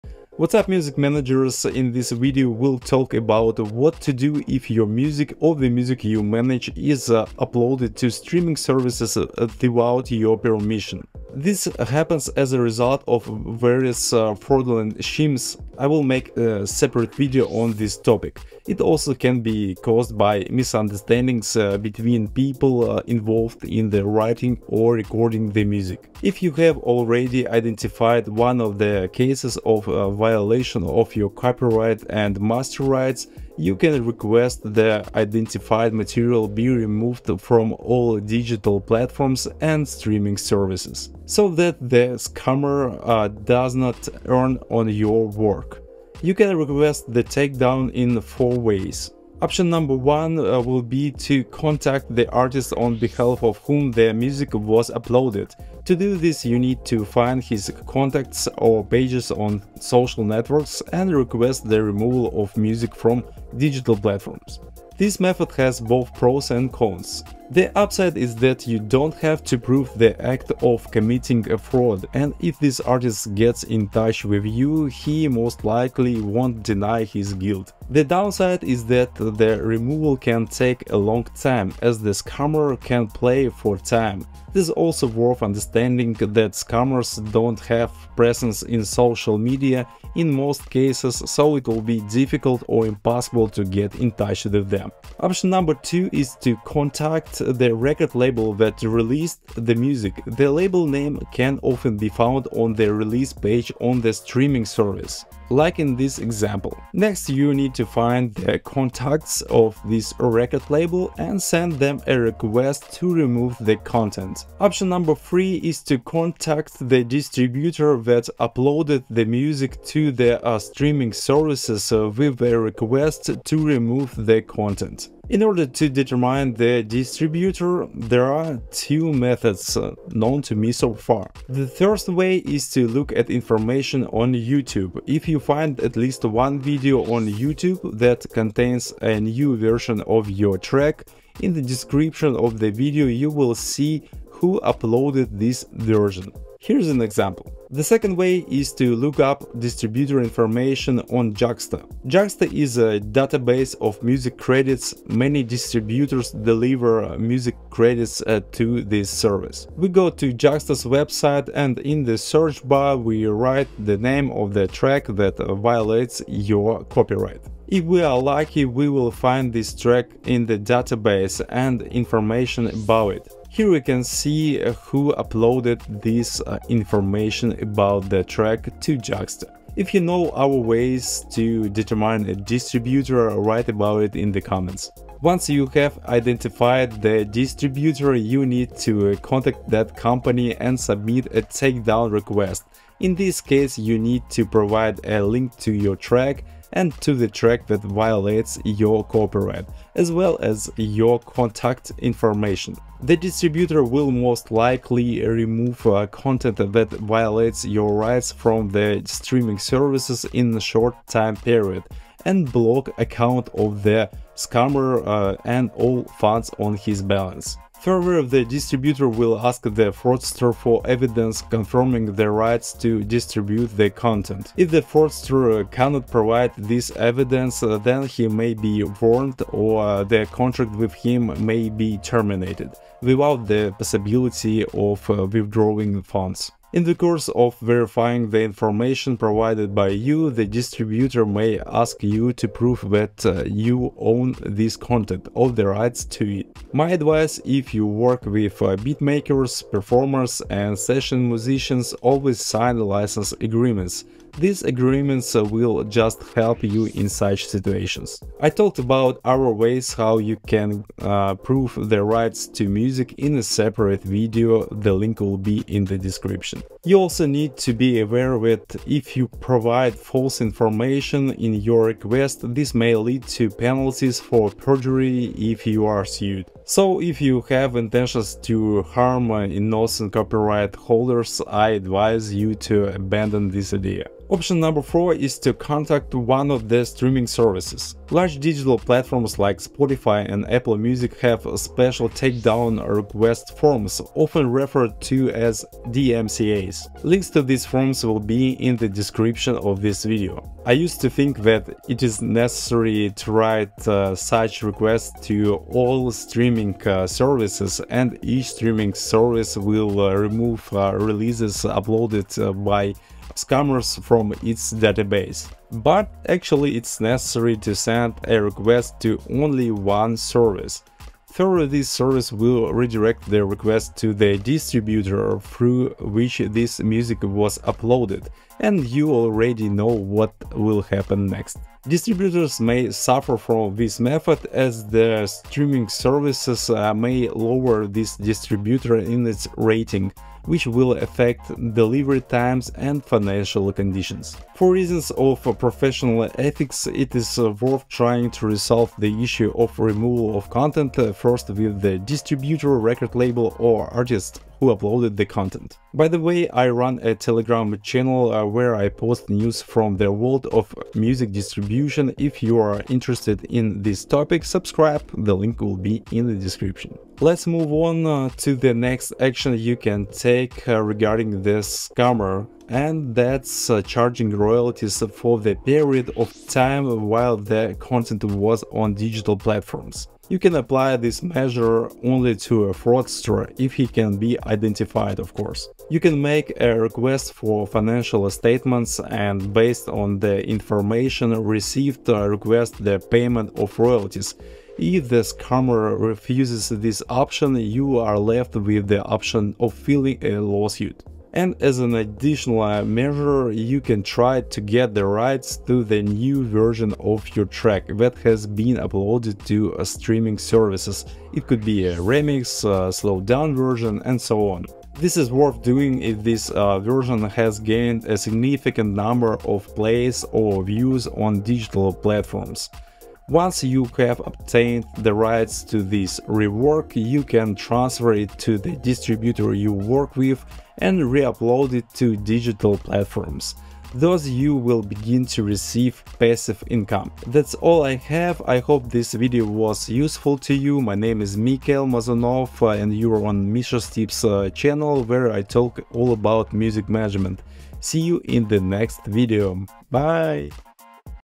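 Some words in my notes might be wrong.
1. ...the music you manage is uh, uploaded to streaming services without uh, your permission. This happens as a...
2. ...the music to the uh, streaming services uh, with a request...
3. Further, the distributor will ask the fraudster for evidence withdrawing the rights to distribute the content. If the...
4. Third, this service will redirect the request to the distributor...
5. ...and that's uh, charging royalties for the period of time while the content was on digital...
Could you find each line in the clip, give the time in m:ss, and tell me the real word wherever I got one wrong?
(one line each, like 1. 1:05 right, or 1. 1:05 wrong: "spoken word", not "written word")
1. 0:05 right
2. 1:59 right
3. 3:37 wrong: "confirming", not "withdrawing"
4. 5:21 right
5. 6:12 right.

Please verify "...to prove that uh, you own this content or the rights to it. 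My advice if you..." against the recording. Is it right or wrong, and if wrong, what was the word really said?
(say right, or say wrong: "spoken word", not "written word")
right.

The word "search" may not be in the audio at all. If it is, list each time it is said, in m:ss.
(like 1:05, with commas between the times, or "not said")
2:42.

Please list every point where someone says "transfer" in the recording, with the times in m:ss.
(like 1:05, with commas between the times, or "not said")
7:07.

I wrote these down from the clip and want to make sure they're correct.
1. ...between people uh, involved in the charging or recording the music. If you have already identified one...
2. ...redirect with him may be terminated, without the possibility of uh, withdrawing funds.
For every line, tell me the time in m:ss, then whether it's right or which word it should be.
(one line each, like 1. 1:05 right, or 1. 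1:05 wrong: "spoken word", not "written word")
1. 0:21 wrong: "writing", not "charging"
2. 3:50 wrong: "contract", not "redirect".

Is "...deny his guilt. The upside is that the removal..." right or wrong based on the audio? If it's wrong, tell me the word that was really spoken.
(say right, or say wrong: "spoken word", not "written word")
wrong: "downside", not "upside".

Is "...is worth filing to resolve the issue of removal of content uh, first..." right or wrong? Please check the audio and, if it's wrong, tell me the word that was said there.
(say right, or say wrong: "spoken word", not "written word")
wrong: "trying", not "filing".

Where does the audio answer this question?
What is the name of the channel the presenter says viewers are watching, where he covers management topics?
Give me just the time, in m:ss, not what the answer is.
7:23.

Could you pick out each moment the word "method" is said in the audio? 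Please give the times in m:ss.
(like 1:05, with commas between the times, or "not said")
1:05, 2:09, 5:33.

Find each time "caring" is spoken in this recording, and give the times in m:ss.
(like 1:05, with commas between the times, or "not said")
not said.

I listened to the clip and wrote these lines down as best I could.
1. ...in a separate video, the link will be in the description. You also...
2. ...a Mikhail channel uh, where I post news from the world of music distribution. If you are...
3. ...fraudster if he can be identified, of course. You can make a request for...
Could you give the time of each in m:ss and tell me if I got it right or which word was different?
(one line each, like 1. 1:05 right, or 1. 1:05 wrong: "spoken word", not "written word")
1. 4:23 right
2. 5:57 wrong: "Telegram", not "Mikhail"
3. 6:22 right.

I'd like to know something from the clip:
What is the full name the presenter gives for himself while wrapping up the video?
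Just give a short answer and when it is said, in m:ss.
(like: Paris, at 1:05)
Mikhail Mazanov, at 7:21.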